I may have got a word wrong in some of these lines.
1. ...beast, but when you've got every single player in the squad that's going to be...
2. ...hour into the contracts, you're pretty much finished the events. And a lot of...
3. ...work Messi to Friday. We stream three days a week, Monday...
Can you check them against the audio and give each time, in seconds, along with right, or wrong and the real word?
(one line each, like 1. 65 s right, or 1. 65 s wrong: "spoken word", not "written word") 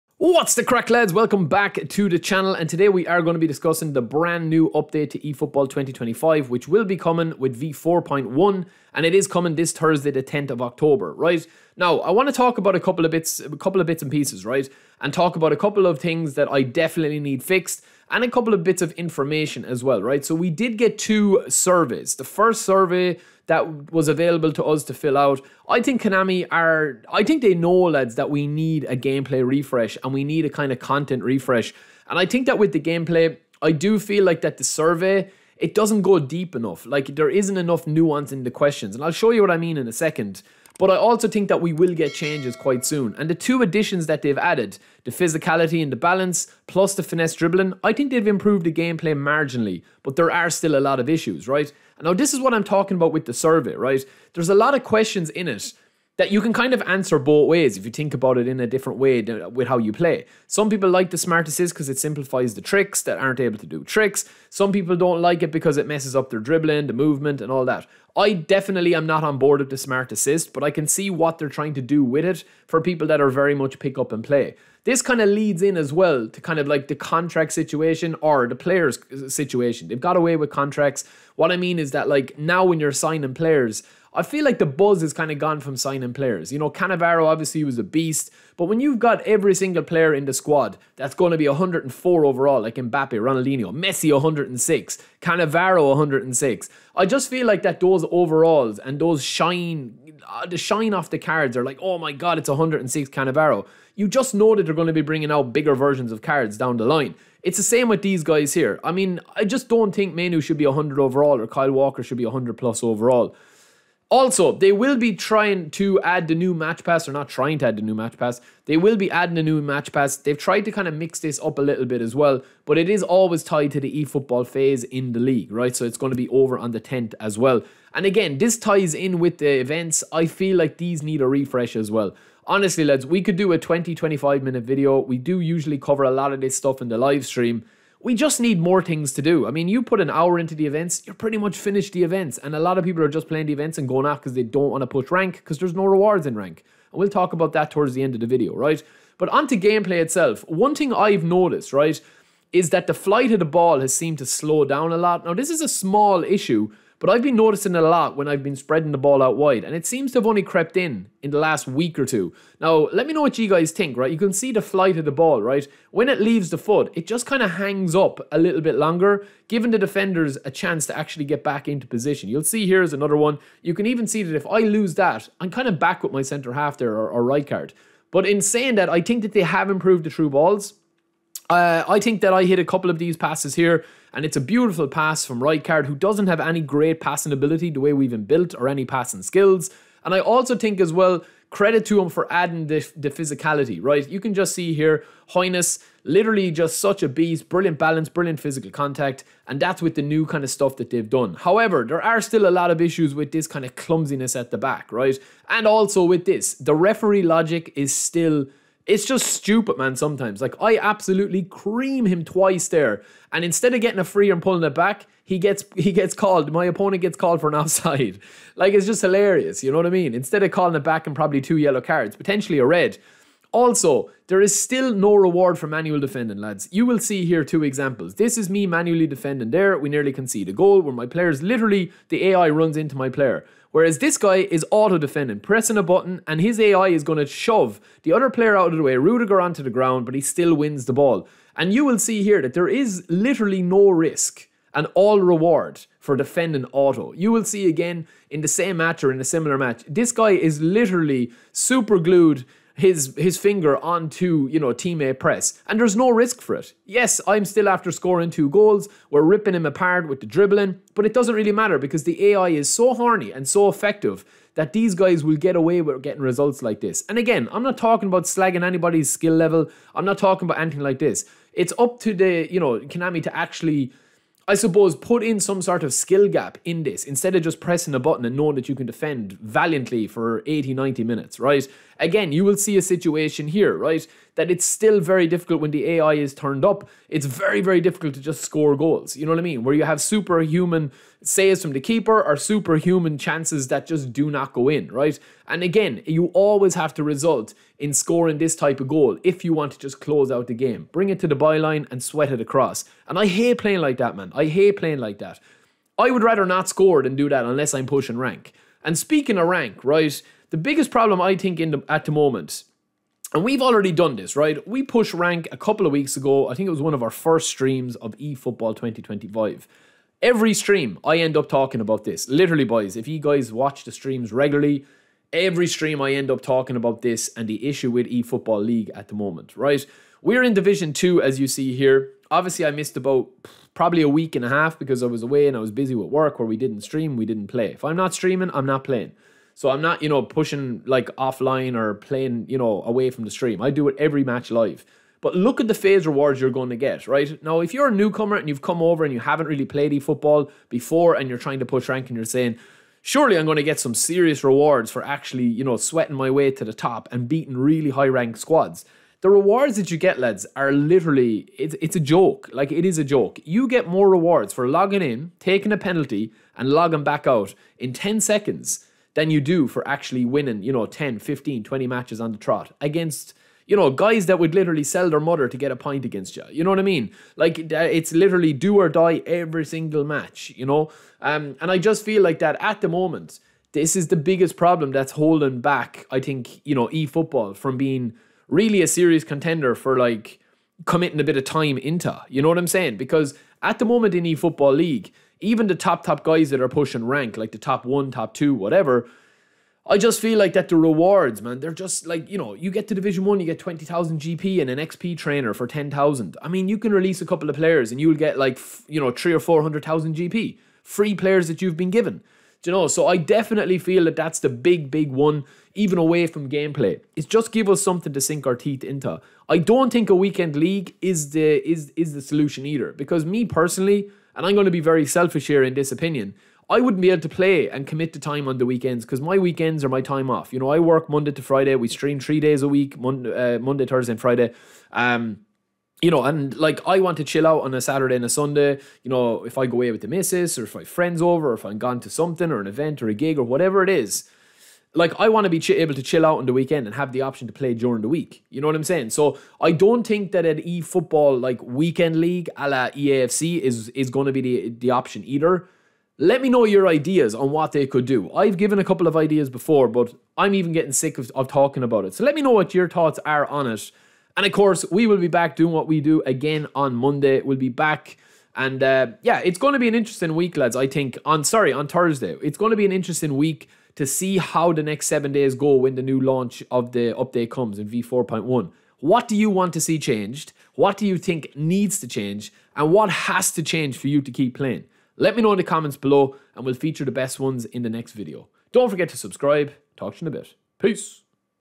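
1. 87 s right
2. 140 s wrong: "events", not "contracts"
3. 430 s wrong: "Monday", not "Messi".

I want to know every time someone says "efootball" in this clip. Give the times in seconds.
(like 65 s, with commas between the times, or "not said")
5 s, 124 s, 318 s, 328 s, 349 s.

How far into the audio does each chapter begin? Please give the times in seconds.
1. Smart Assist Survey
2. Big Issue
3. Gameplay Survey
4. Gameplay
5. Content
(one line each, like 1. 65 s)
1. 60 s
2. 311 s
3. 20 s
4. 140 s
5. 74 s.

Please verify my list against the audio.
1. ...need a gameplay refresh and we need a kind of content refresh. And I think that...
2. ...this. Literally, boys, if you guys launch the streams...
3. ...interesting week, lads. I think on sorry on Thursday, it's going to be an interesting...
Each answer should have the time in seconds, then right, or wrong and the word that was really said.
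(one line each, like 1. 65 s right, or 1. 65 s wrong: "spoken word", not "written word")
1. 28 s right
2. 322 s wrong: "watch", not "launch"
3. 469 s right.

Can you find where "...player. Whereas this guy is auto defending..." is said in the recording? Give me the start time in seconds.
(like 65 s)
233 s.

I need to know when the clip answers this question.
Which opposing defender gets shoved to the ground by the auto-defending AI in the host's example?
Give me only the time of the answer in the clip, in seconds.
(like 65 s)
238 s.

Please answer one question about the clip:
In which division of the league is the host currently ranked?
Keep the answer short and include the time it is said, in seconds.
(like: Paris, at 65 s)
Division 2, at 330 s.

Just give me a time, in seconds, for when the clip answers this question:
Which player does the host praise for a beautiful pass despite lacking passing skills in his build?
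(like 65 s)
185 s.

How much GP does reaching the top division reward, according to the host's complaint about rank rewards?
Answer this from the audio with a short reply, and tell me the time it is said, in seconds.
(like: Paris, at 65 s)
20,000 GP, at 403 s.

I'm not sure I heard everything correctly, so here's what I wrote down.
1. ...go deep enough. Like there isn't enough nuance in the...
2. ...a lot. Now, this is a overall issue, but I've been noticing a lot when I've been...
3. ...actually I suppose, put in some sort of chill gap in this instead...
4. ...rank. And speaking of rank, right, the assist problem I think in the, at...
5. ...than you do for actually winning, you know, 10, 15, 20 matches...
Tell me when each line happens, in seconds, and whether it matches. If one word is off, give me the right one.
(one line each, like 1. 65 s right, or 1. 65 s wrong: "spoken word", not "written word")
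1. 36 s right
2. 154 s wrong: "small", not "overall"
3. 273 s wrong: "skill", not "chill"
4. 308 s wrong: "biggest", not "assist"
5. 369 s right.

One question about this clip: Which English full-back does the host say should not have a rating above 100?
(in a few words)
Kyle Walker.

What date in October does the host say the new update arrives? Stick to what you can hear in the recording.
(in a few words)
10th of October.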